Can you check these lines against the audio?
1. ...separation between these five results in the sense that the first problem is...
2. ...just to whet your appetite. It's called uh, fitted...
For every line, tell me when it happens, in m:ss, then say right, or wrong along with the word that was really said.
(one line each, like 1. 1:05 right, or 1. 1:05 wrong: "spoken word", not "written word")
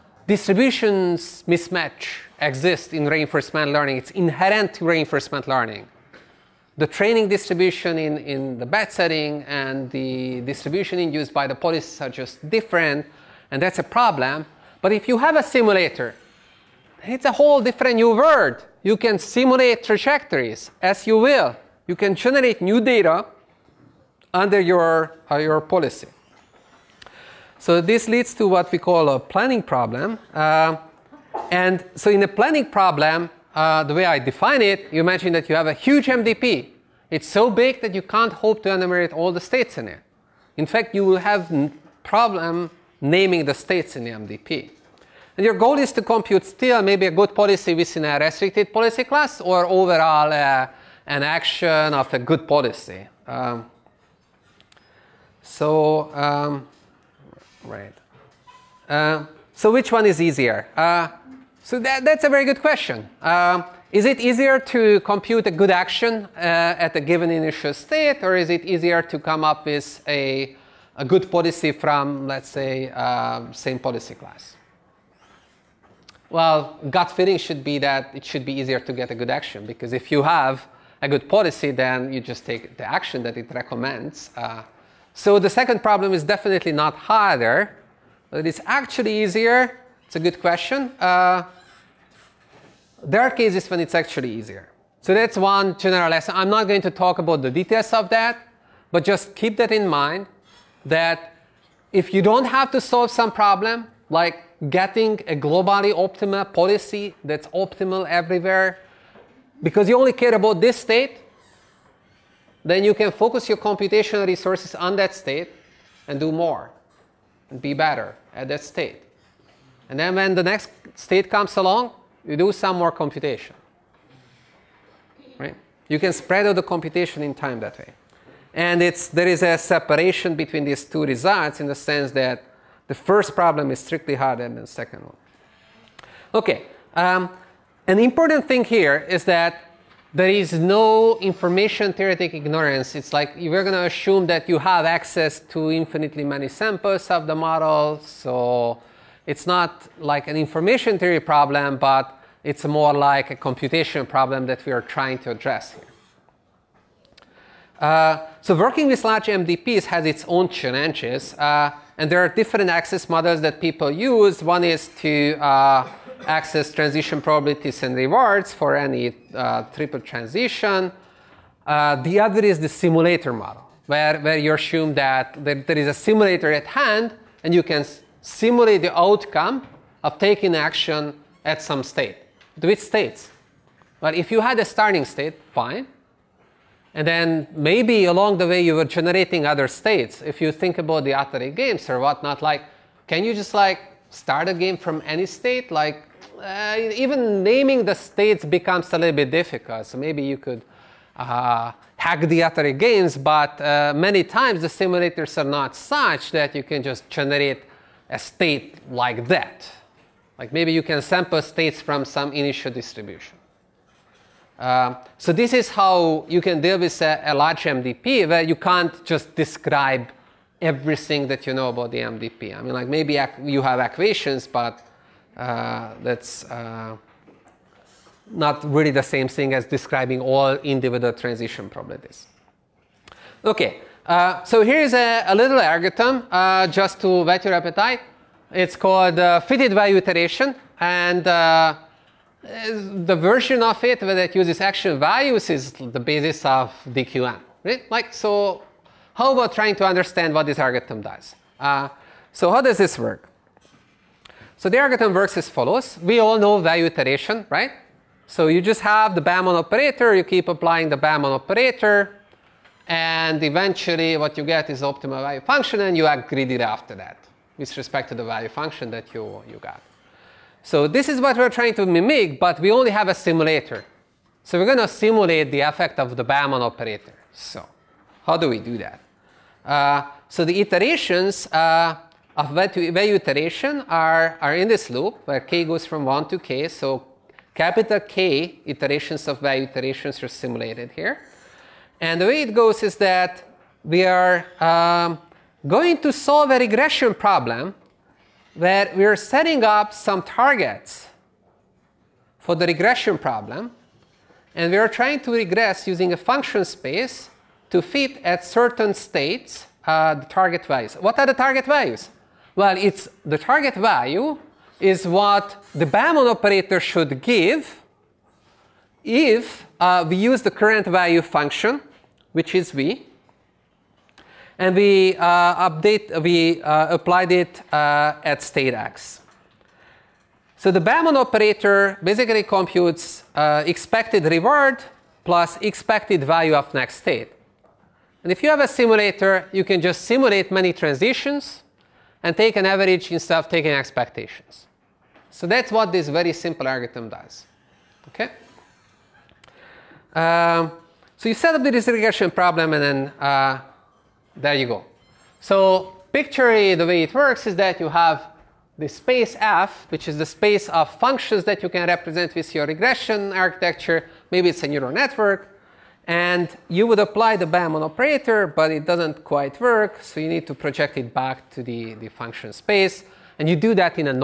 1. 2:09 wrong: "two", not "five"
2. 3:56 right.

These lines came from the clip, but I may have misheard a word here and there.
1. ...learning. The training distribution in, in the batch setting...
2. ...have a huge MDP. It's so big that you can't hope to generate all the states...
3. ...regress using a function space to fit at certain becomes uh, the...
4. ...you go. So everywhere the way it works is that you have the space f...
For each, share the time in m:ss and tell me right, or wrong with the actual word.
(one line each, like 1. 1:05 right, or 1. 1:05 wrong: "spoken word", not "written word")
1. 0:05 right
2. 0:35 wrong: "enumerate", not "generate"
3. 5:05 wrong: "states", not "becomes"
4. 5:54 wrong: "picture", not "everywhere".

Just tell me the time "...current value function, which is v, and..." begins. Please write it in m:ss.
5:20.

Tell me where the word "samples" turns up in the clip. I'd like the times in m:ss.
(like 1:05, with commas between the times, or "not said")
2:26, 3:31.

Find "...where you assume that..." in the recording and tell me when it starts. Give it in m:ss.
2:54.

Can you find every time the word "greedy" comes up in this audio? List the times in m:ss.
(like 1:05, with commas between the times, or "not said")
4:26.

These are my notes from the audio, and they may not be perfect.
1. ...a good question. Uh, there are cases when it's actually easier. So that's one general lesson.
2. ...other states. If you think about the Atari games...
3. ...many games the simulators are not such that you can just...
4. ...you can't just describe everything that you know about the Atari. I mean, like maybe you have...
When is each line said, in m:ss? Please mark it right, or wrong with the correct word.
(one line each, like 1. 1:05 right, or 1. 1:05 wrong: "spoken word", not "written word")
1. 1:30 right
2. 3:09 right
3. 3:23 wrong: "times", not "games"
4. 3:38 wrong: "MDP", not "Atari".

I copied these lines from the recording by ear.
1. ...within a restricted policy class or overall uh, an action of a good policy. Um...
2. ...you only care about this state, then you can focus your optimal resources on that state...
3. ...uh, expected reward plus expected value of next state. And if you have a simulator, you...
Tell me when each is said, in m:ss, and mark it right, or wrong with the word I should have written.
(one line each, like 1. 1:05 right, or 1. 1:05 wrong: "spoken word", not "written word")
1. 0:47 right
2. 1:49 wrong: "computational", not "optimal"
3. 5:33 right.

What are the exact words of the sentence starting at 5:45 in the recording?
So that's what this very simple algorithm does.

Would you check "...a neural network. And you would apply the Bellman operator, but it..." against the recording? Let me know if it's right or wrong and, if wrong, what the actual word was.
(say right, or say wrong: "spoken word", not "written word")
right.